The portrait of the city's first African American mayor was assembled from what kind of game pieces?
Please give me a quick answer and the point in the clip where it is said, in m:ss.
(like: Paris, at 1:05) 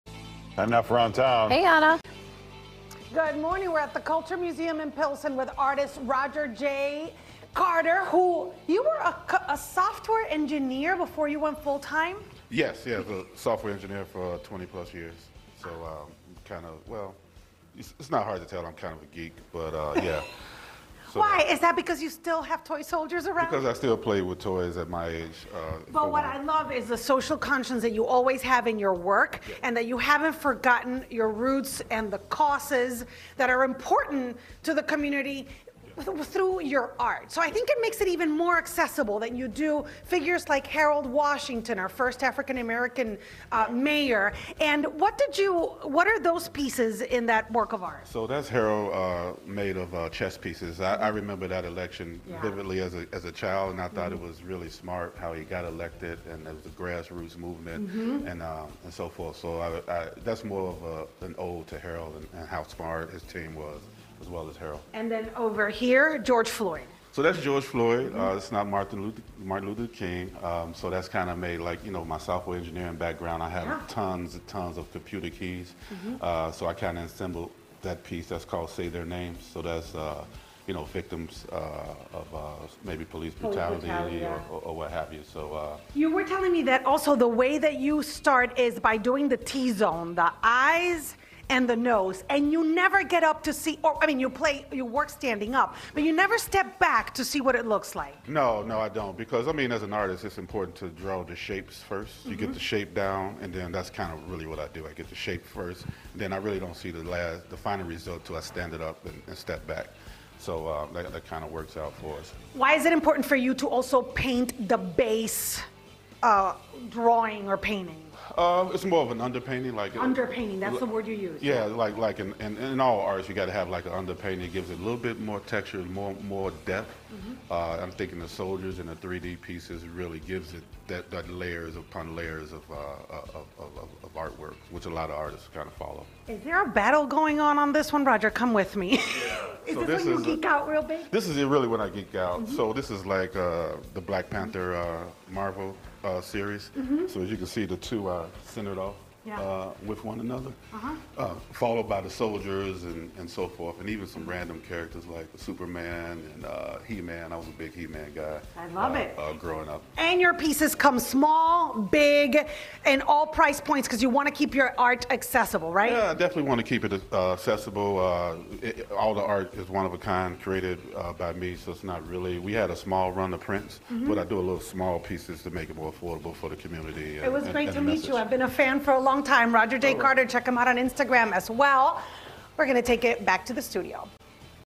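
Chess pieces, at 0:50.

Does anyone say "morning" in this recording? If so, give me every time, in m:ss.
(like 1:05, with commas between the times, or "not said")
0:03.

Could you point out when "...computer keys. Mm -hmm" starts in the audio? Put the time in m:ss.
1:14.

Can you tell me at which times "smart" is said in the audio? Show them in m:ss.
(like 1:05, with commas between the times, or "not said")
0:54, 1:02.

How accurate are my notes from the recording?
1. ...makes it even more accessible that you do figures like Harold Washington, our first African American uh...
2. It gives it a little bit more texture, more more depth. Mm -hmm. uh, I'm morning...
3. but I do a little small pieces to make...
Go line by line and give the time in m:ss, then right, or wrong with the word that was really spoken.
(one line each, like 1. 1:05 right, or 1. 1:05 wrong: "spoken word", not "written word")
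1. 0:37 right
2. 2:04 wrong: "thinking", not "morning"
3. 2:54 right.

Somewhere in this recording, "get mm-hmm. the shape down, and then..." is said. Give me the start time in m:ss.
1:42.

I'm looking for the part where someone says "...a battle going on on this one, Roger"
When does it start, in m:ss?
2:16.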